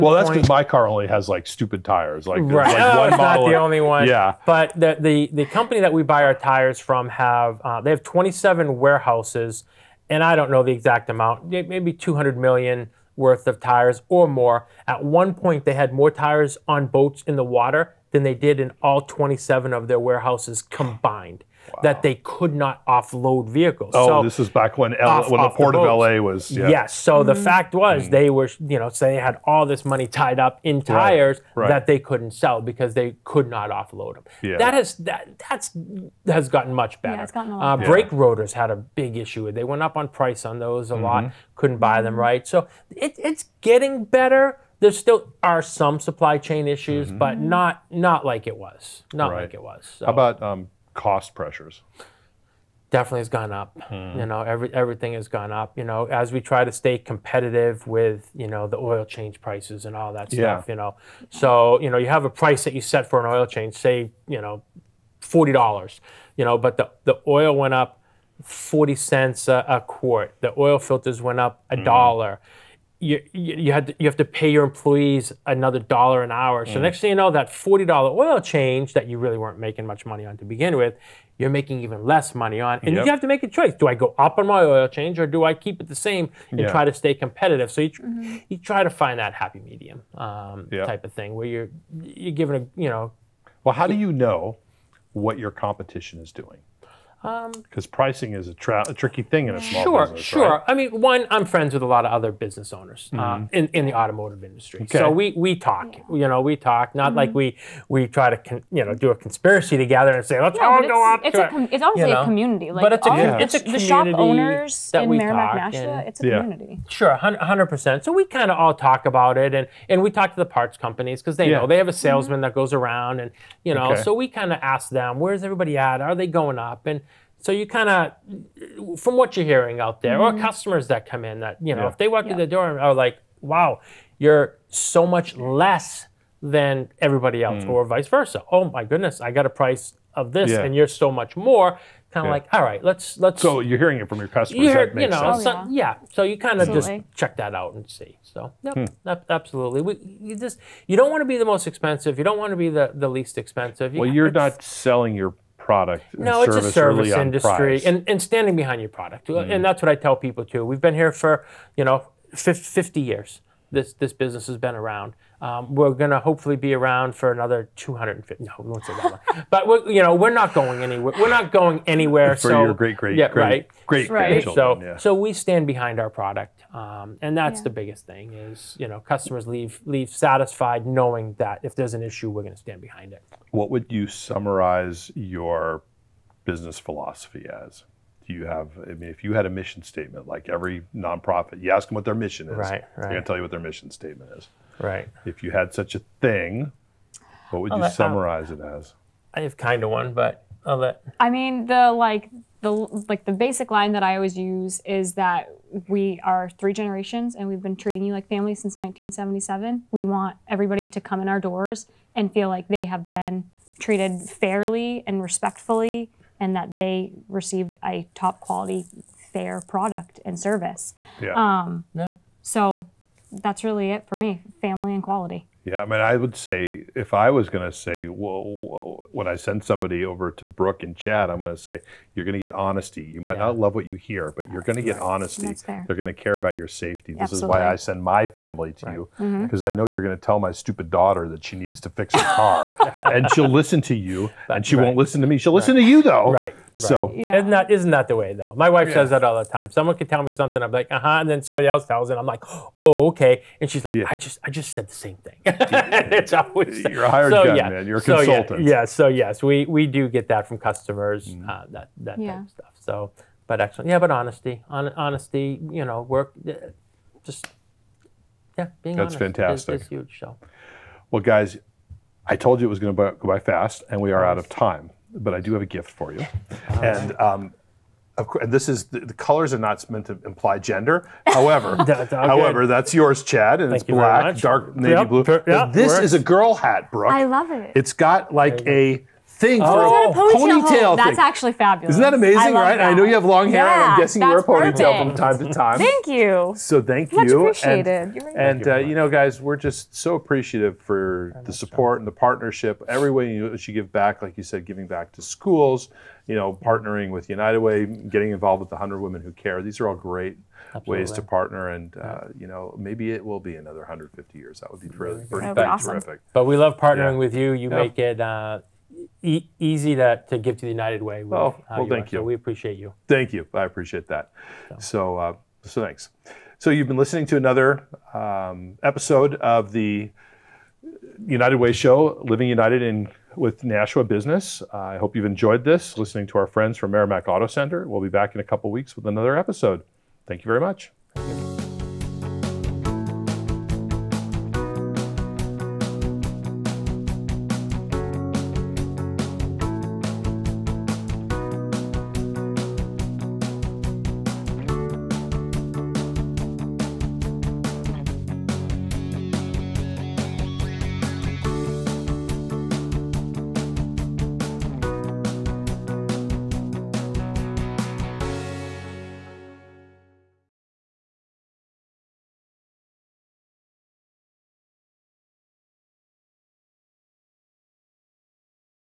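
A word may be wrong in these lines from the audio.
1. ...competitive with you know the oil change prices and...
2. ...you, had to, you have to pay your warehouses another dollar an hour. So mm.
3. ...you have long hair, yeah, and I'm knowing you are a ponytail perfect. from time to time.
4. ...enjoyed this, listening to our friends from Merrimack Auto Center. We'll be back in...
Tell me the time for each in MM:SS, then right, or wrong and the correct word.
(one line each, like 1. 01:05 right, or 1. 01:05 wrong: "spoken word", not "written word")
1. 00:56 right
2. 01:13 wrong: "employees", not "warehouses"
3. 04:53 wrong: "guessing", not "knowing"
4. 05:35 right.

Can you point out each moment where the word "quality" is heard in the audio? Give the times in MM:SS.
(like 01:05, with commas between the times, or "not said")
03:38, 03:45.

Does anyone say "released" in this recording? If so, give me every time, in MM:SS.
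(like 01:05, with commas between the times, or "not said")
not said.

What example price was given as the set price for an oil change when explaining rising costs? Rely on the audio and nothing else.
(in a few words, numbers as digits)
$40.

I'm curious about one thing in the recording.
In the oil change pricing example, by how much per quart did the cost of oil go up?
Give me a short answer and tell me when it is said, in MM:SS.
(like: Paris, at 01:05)
40 cents, at 01:08.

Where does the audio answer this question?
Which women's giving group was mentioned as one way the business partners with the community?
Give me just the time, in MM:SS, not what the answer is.
05:08.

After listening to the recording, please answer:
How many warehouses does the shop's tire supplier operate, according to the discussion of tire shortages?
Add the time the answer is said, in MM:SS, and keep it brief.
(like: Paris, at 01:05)
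27, at 00:08.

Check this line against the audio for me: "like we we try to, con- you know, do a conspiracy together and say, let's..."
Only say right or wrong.
right.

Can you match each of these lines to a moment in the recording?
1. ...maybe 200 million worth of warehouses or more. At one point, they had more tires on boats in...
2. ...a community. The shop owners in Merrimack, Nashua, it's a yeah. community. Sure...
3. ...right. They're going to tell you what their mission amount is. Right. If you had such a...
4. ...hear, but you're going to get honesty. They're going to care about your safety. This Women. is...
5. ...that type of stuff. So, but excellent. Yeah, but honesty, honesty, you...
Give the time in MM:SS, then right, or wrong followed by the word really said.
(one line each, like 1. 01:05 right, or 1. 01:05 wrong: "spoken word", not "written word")
1. 00:11 wrong: "tires", not "warehouses"
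2. 01:53 right
3. 03:12 wrong: "statement", not "amount"
4. 03:53 wrong: "Absolutely", not "Women"
5. 04:21 right.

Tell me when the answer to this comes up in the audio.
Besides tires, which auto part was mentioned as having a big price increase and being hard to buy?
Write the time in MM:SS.
00:37.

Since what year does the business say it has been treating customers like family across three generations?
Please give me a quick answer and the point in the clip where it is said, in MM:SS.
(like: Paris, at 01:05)
1977, at 03:28.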